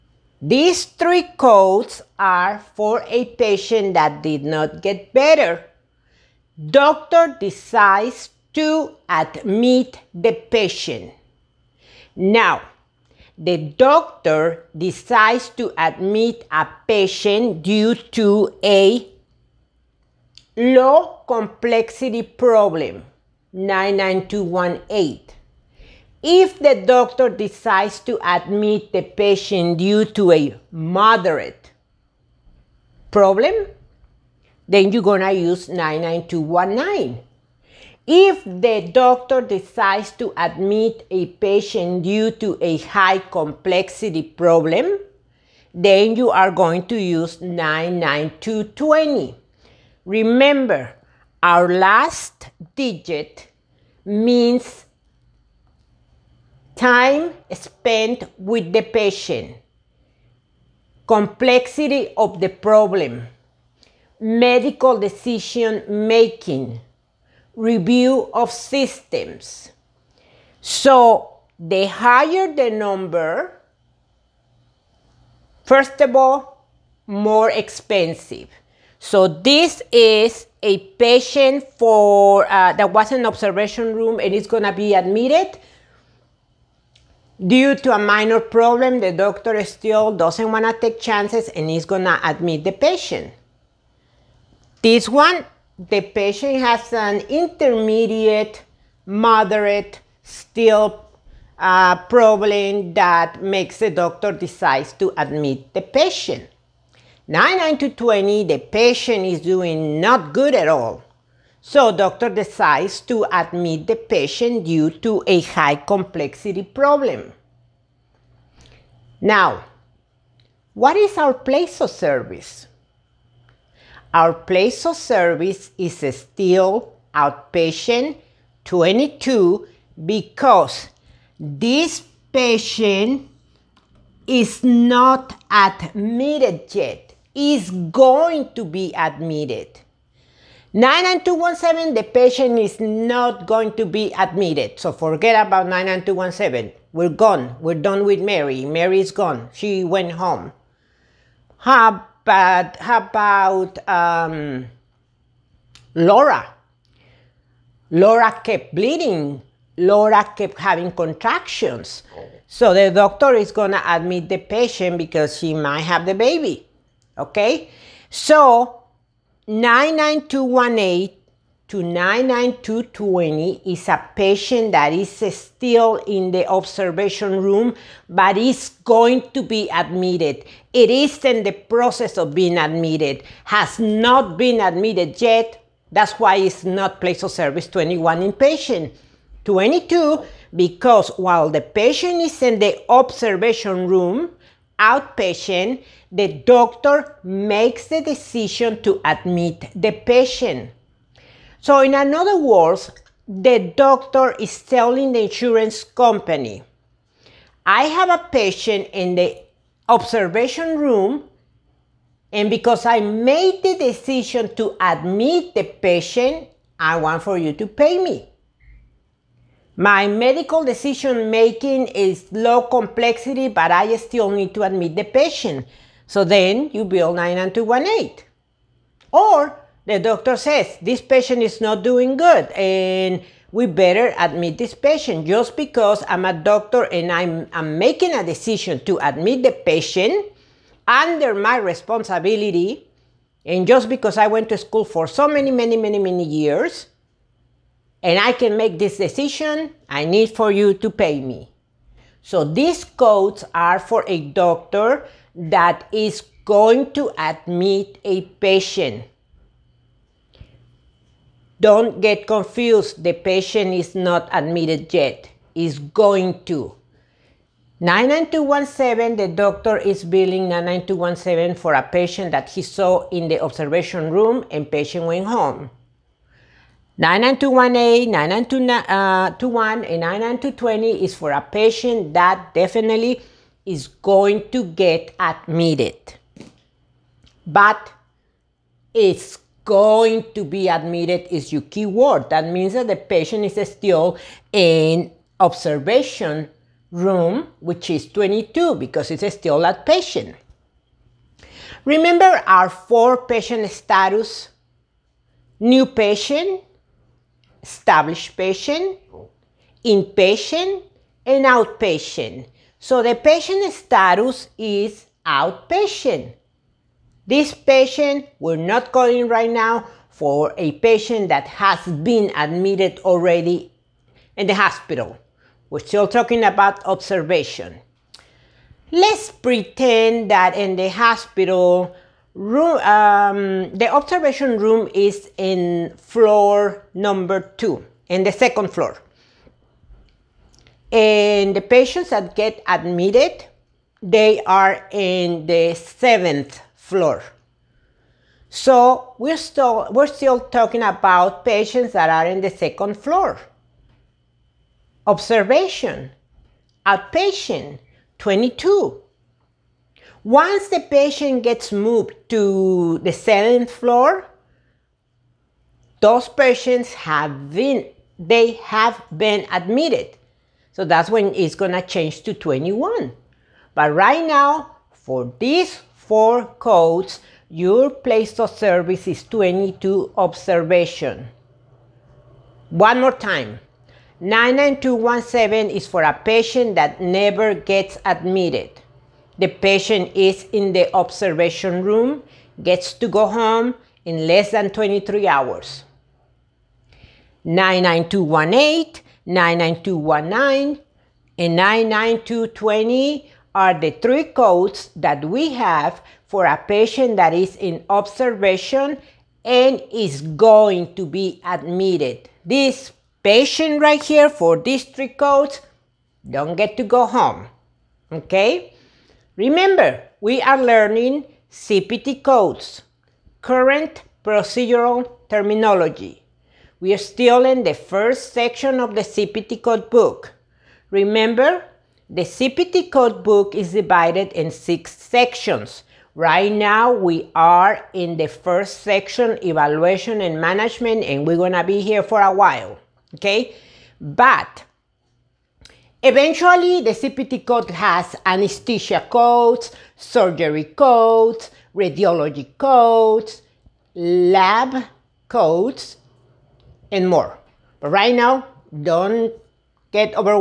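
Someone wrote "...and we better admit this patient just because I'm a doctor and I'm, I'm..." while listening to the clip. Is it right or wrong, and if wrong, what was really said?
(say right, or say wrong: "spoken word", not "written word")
right.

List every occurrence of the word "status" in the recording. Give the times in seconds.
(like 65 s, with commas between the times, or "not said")
303 s, 313 s.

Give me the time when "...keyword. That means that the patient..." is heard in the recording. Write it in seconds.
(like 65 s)
291 s.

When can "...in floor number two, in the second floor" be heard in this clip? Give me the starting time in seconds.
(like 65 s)
335 s.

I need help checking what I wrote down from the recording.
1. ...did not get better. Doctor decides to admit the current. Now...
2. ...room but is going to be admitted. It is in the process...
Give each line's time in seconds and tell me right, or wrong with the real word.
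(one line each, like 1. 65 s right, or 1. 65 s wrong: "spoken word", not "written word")
1. 4 s wrong: "patient", not "current"
2. 177 s right.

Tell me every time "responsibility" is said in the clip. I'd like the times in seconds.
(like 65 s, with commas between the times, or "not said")
241 s.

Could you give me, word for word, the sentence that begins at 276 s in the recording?
99218, 99221, uh, and 99220 is for a patient that definitely is going to get admitted.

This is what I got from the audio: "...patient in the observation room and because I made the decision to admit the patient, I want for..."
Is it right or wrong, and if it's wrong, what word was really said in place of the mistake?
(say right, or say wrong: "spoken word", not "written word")
right.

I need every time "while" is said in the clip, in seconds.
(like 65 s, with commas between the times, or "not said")
191 s, 442 s.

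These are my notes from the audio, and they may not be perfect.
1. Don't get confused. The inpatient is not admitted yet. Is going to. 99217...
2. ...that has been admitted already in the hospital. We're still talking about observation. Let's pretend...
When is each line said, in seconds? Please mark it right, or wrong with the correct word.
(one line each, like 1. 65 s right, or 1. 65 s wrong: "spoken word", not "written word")
1. 261 s wrong: "patient", not "inpatient"
2. 321 s right.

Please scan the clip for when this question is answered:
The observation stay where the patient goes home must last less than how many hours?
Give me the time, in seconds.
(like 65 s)
394 s.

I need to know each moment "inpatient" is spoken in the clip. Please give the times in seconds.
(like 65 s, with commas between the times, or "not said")
188 s, 309 s.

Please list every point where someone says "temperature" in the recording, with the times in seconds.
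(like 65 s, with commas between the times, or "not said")
not said.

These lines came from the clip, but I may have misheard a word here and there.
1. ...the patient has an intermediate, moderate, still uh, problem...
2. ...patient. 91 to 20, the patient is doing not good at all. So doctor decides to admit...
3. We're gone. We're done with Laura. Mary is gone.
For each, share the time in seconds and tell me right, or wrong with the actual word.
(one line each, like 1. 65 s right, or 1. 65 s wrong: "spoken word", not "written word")
1. 95 s right
2. 105 s wrong: "99", not "91"
3. 146 s wrong: "Mary", not "Laura".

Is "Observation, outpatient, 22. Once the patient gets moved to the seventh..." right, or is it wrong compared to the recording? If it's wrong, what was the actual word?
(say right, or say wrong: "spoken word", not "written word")
right.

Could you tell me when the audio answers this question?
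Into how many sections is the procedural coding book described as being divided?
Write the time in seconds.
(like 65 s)
434 s.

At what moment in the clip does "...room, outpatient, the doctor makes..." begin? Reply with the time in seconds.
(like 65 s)
193 s.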